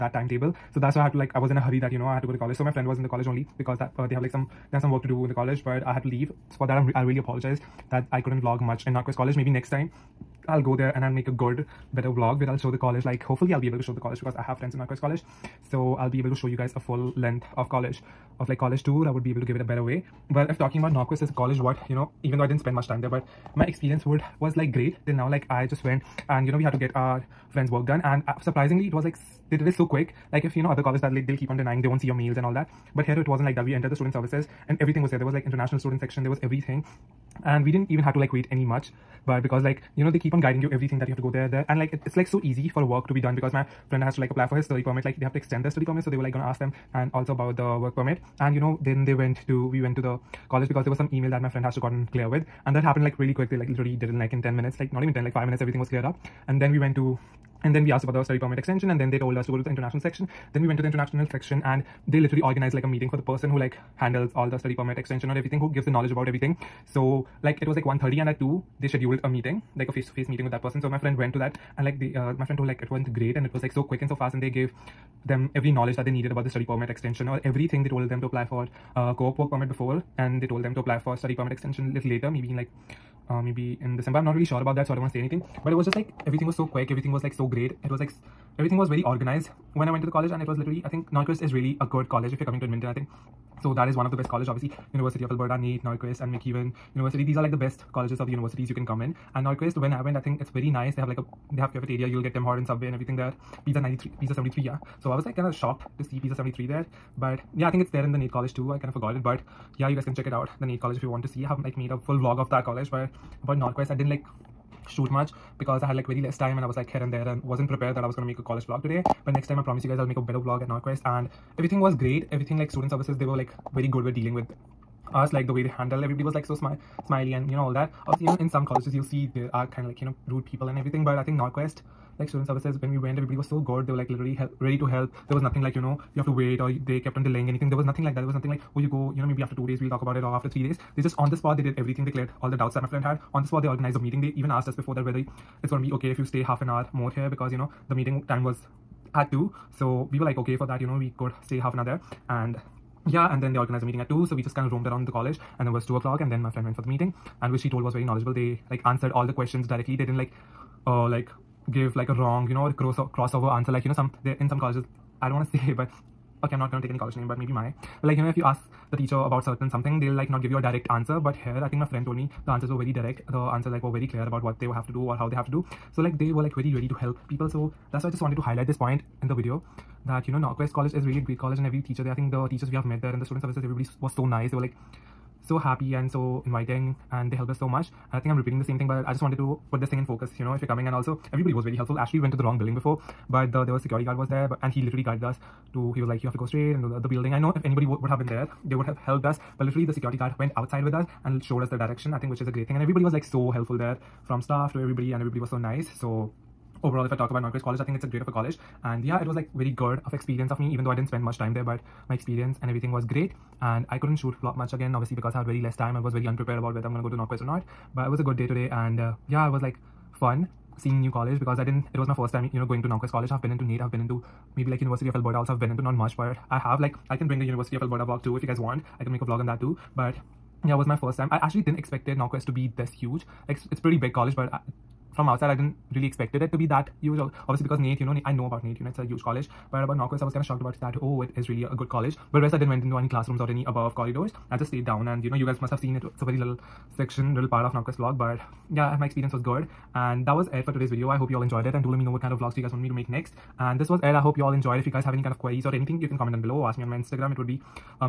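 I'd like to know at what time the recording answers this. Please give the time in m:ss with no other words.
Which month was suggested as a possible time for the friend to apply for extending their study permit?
1:23.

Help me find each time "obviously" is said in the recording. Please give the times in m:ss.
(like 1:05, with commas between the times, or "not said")
1:34, 2:08, 3:34, 3:57.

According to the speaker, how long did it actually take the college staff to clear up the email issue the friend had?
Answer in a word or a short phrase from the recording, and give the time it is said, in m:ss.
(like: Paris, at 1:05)
5 minutes, at 0:55.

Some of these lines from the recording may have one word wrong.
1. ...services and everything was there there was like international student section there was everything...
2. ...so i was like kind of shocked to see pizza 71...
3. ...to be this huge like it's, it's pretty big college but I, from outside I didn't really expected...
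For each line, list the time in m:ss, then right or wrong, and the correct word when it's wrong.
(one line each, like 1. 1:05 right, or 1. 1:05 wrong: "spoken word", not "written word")
1. 0:34 right
2. 1:45 wrong: "73", not "71"
3. 3:52 right.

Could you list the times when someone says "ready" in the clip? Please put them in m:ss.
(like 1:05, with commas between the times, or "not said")
2:14, 2:56.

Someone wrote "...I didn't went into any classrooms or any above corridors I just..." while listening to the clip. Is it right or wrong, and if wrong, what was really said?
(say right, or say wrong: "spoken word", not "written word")
right.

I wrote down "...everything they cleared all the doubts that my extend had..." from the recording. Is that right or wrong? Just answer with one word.
wrong.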